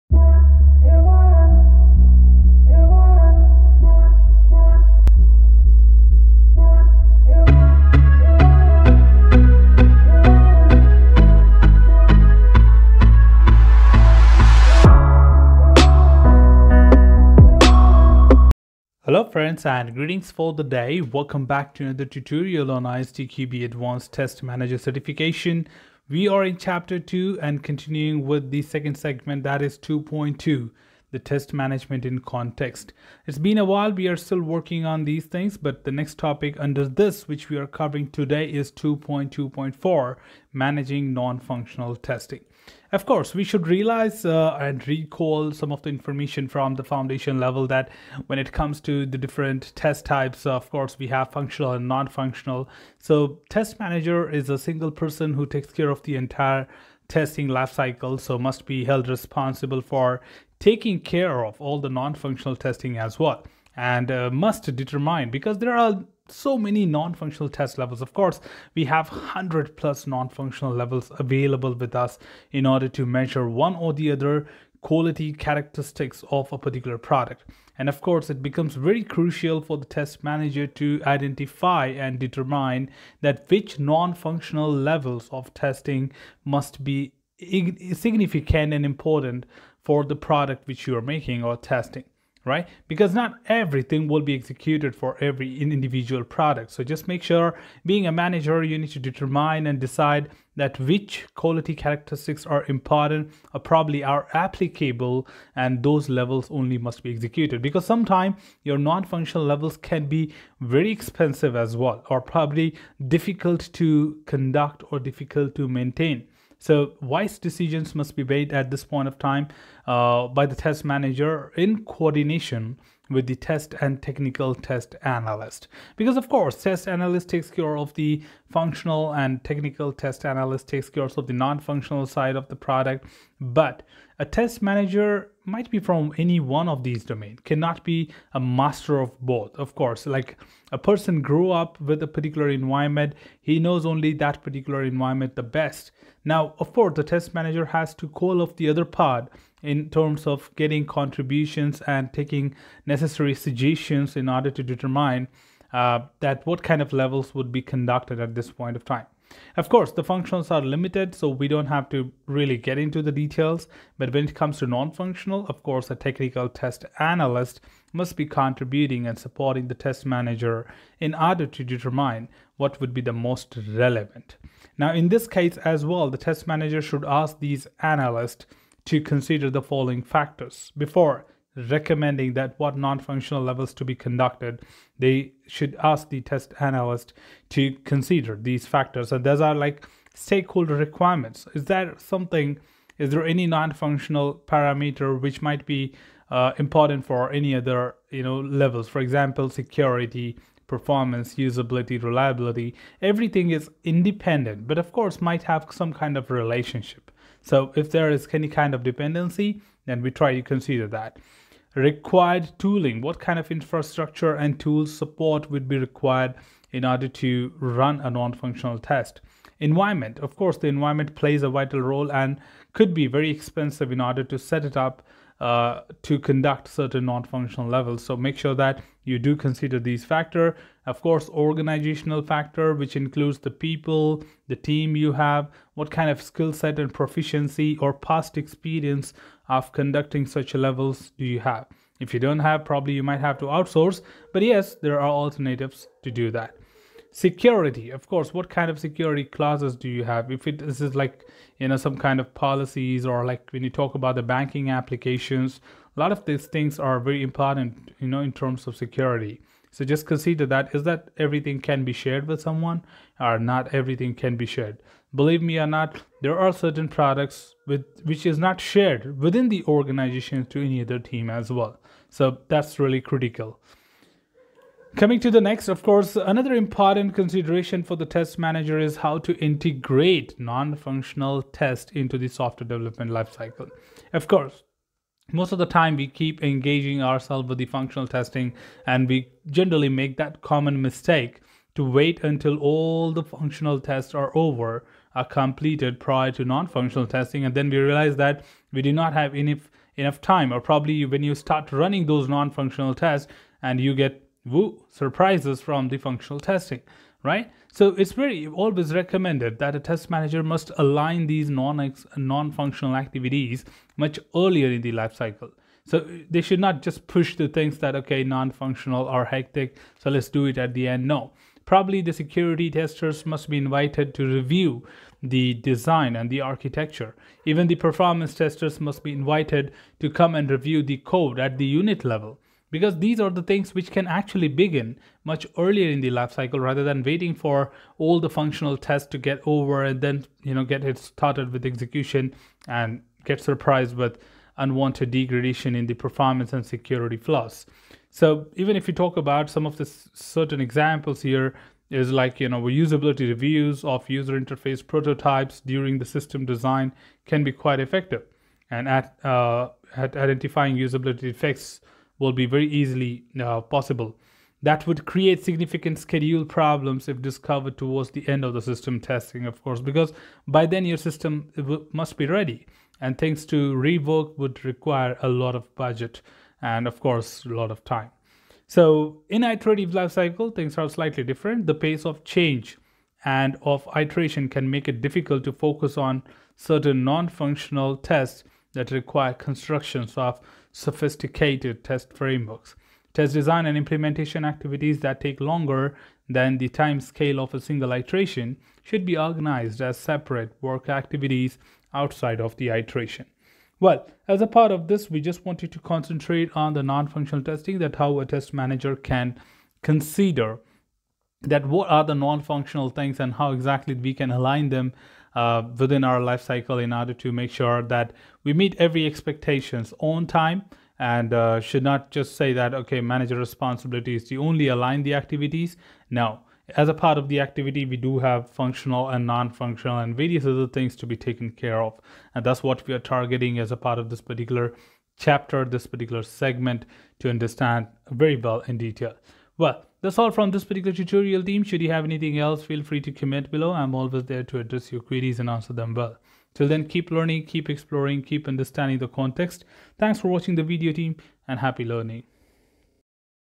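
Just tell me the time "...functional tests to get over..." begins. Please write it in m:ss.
5:38.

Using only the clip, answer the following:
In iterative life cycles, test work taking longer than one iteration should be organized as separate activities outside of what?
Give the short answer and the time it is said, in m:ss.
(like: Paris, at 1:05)
the iteration, at 6:41.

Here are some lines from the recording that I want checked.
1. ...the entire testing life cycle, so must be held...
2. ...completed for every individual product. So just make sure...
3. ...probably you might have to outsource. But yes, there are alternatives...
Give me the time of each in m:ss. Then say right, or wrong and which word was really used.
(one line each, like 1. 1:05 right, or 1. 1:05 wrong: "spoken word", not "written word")
1. 0:56 right
2. 1:34 wrong: "executed", not "completed"
3. 4:02 right.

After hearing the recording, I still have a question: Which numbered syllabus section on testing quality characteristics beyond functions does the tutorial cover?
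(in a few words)
2.2.4.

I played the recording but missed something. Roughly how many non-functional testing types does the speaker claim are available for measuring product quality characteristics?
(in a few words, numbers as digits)
100 plus.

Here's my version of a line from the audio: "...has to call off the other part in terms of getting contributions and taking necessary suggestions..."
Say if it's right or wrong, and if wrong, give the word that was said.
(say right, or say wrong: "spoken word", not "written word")
right.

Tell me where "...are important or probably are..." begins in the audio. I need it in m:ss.
1:42.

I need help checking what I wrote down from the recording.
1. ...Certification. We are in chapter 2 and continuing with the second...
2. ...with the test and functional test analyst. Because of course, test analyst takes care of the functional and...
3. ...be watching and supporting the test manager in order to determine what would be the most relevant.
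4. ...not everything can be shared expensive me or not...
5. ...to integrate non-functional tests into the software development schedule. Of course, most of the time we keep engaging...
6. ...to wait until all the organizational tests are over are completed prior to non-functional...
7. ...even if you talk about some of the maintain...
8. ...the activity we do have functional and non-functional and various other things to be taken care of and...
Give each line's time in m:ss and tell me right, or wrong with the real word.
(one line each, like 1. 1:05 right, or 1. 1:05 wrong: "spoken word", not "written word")
1. 0:24 right
2. 2:03 wrong: "technical", not "functional"
3. 2:48 wrong: "contributing", not "watching"
4. 4:23 wrong: "believe", not "expensive"
5. 4:39 wrong: "lifecycle", not "schedule"
6. 4:51 wrong: "functional", not "organizational"
7. 5:48 wrong: "certain", not "maintain"
8. 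7:07 right.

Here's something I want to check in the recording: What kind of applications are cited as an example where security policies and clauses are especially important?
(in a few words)
banking applications.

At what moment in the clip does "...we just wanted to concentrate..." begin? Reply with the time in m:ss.
6:45.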